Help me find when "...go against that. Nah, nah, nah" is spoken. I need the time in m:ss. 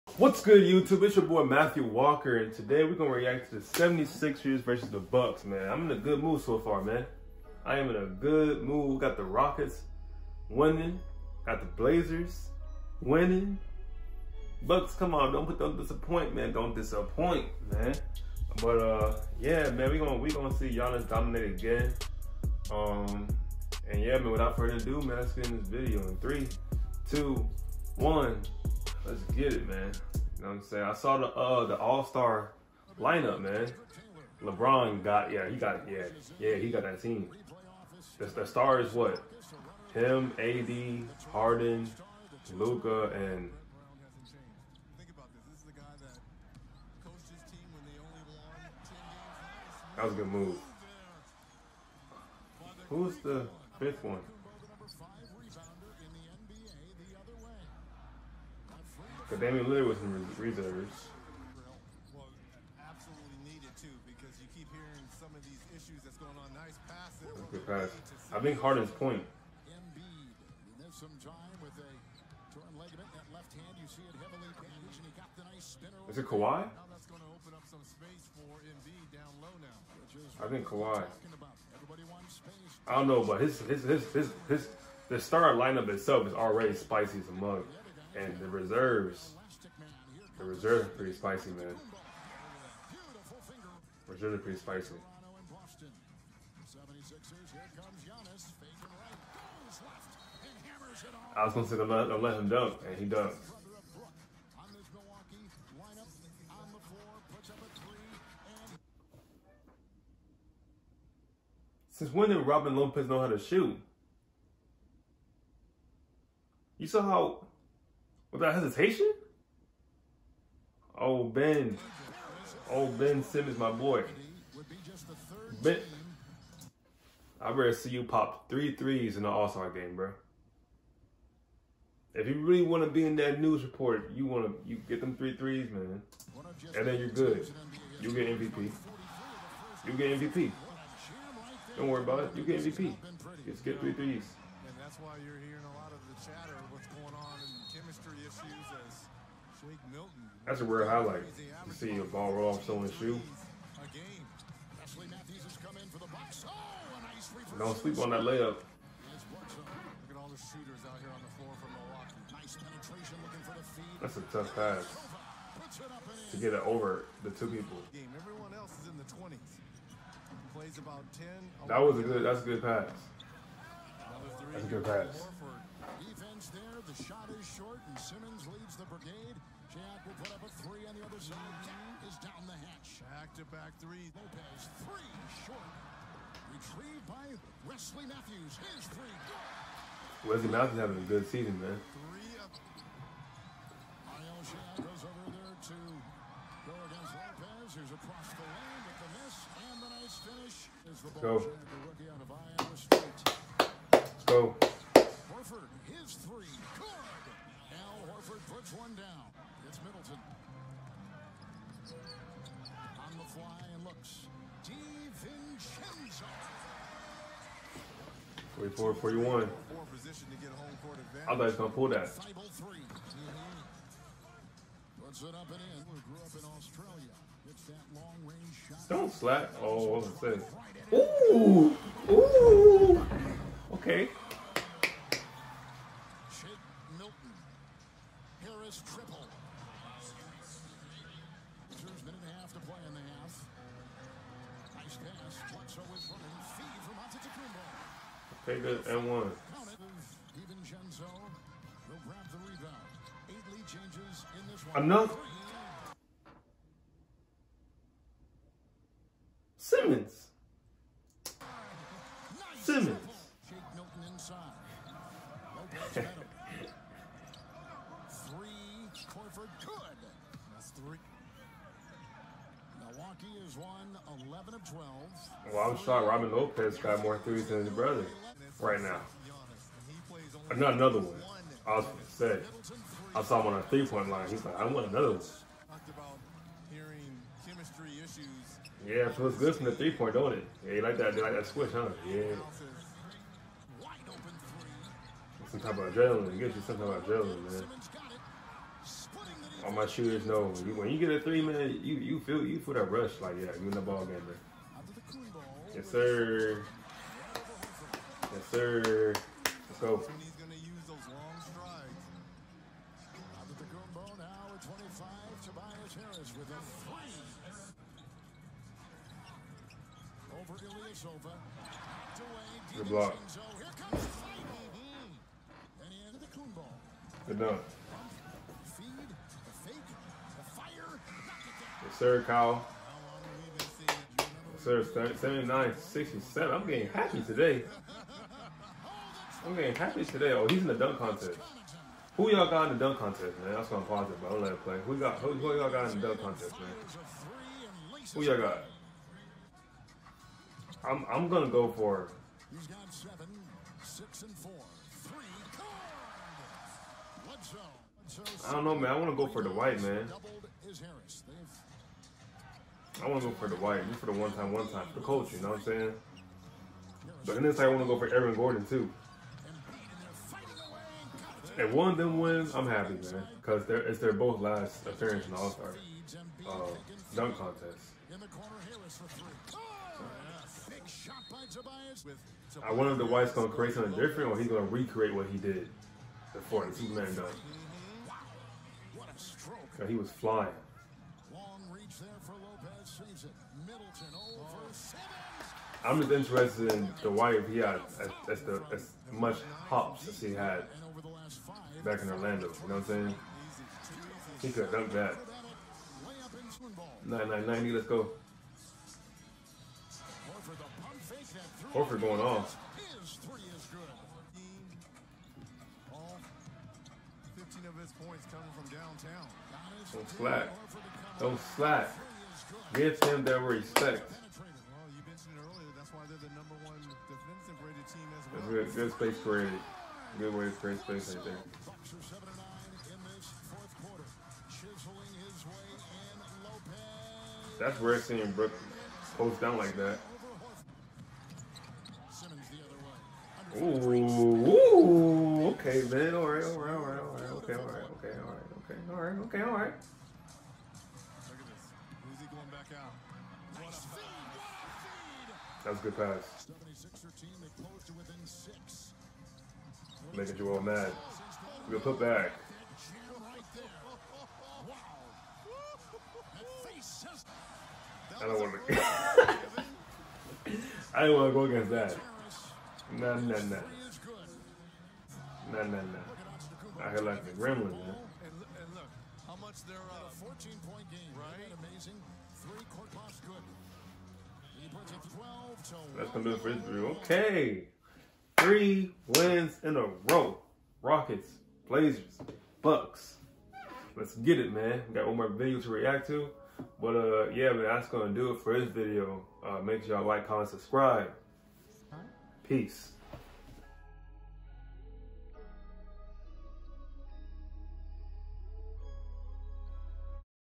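7:51.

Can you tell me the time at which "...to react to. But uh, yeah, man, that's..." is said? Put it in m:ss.
8:15.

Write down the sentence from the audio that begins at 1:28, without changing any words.
And the reserves, the reserves are pretty spicy, man.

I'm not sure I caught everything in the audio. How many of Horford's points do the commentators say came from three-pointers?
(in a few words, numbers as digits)
15.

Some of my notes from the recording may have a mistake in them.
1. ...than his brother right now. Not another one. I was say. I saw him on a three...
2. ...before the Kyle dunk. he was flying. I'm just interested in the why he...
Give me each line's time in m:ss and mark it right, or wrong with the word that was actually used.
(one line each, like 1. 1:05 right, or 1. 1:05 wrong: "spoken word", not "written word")
1. 4:37 right
2. 6:26 wrong: "Superman", not "Kyle".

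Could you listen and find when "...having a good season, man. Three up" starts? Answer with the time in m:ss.
3:10.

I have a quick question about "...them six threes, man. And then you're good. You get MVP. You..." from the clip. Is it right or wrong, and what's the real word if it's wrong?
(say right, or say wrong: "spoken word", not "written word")
wrong: "three", not "six".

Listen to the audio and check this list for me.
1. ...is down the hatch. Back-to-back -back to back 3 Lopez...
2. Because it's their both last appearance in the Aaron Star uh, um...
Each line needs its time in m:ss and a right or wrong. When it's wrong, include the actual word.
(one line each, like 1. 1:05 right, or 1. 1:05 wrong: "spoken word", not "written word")
1. 3:02 right
2. 6:13 wrong: "All", not "Aaron".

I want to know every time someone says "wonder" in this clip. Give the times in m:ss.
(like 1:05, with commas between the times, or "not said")
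6:22.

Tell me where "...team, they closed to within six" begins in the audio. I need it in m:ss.
7:37.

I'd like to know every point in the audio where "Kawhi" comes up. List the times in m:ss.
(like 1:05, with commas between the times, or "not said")
1:16, 1:20.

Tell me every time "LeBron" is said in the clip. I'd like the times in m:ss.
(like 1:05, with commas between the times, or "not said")
0:34.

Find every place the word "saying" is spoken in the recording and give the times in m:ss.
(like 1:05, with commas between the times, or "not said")
0:30, 6:05, 6:42.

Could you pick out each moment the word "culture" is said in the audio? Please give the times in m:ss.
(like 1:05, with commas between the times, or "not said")
6:05.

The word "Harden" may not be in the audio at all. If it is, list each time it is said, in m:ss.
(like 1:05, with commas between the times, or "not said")
0:41, 1:08.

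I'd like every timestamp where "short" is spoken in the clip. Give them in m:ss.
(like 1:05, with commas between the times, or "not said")
2:57, 3:05.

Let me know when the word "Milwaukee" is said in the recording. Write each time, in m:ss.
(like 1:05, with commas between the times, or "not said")
2:41.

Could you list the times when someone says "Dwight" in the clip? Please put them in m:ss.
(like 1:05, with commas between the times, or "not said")
5:59, 6:03, 6:23.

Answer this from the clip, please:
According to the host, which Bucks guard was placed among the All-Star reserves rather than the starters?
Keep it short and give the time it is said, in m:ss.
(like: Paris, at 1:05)
Damian Lillard, at 0:59.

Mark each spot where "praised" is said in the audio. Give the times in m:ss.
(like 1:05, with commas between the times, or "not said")
not said.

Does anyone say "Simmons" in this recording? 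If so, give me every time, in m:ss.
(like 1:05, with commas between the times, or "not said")
2:03, 2:57.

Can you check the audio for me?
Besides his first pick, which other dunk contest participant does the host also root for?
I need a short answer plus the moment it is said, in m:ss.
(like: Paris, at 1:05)
Aaron Gordon, at 6:08.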